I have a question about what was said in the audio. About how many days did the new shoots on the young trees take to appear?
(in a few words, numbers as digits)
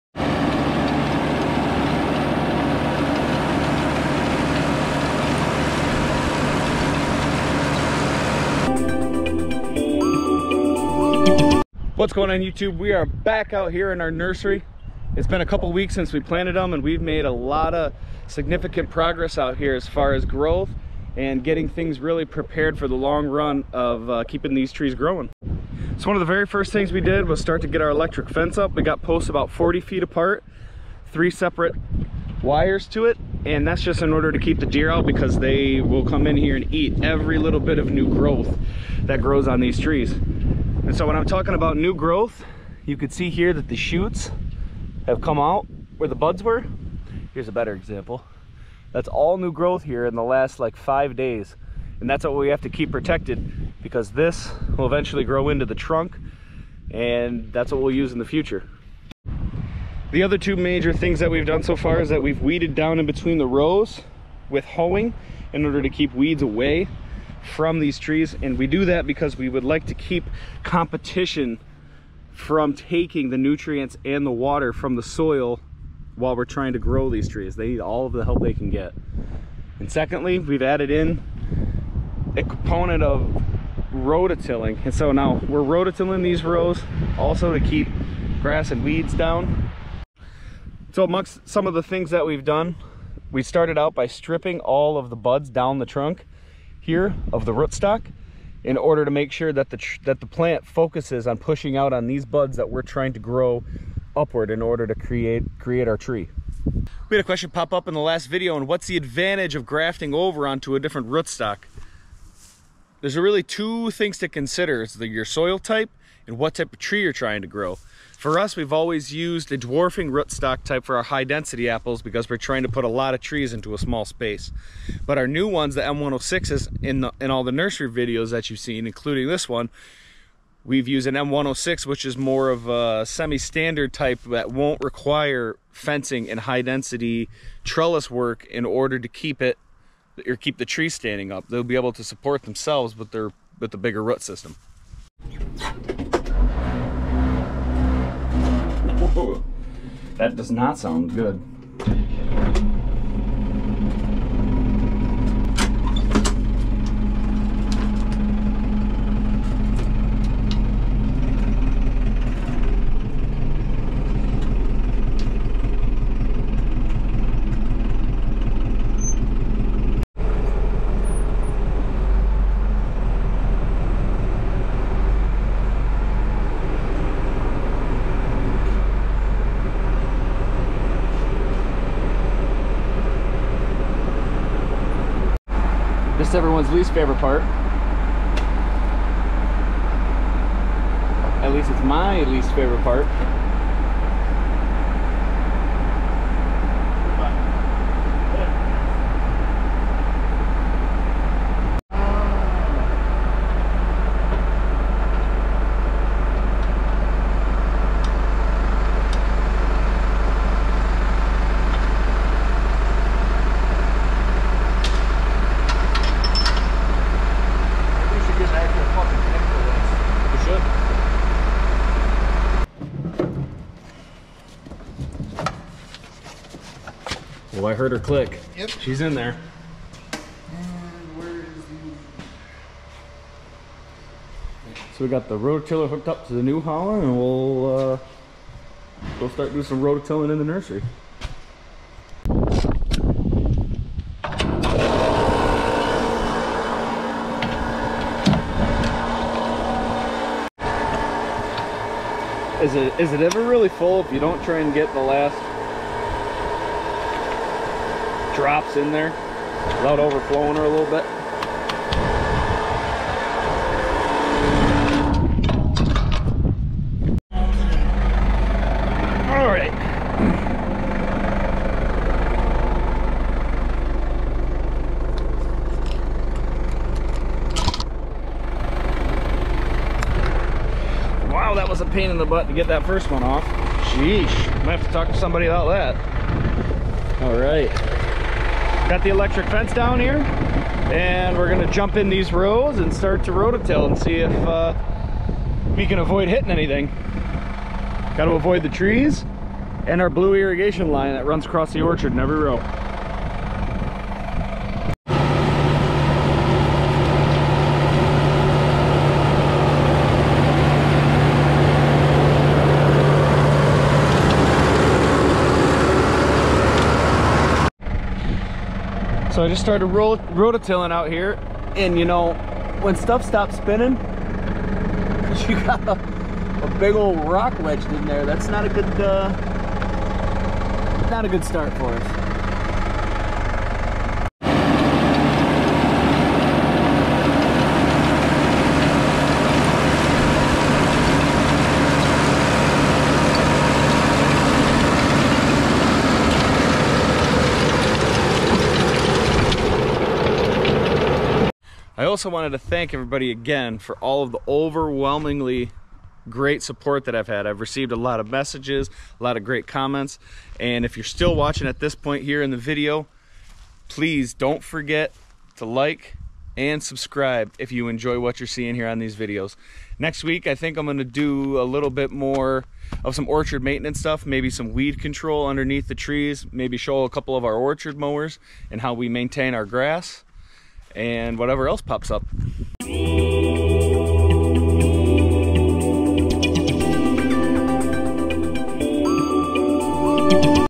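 5.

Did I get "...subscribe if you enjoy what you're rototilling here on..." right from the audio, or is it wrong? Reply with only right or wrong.
wrong.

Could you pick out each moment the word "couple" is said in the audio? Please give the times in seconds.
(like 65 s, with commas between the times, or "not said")
15 s, 377 s.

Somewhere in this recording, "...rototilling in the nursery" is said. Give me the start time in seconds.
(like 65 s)
239 s.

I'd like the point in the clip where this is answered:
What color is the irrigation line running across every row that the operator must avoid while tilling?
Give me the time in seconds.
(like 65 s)
300 s.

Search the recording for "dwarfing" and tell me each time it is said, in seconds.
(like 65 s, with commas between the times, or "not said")
119 s.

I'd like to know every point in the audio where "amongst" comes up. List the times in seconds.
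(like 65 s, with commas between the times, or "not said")
91 s.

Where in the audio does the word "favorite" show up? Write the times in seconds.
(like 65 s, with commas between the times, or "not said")
186 s, 192 s.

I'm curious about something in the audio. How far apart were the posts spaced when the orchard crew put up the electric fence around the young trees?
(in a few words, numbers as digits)
40 feet.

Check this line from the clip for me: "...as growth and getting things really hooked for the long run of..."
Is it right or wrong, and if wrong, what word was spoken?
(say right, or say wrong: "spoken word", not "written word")
wrong: "prepared", not "hooked".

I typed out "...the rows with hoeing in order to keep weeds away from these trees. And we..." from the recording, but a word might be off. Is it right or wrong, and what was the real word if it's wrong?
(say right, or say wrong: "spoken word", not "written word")
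right.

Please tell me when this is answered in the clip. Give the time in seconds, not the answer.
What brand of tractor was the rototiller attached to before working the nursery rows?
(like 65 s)
236 s.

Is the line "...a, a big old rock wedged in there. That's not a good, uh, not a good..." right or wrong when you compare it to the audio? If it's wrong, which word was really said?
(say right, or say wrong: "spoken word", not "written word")
right.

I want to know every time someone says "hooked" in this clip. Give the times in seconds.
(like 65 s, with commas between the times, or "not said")
235 s.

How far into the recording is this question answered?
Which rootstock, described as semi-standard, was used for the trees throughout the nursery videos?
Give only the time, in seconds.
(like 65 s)
131 s.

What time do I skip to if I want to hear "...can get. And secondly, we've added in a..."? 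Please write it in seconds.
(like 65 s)
78 s.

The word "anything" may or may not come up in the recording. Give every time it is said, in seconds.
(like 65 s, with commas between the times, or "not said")
296 s.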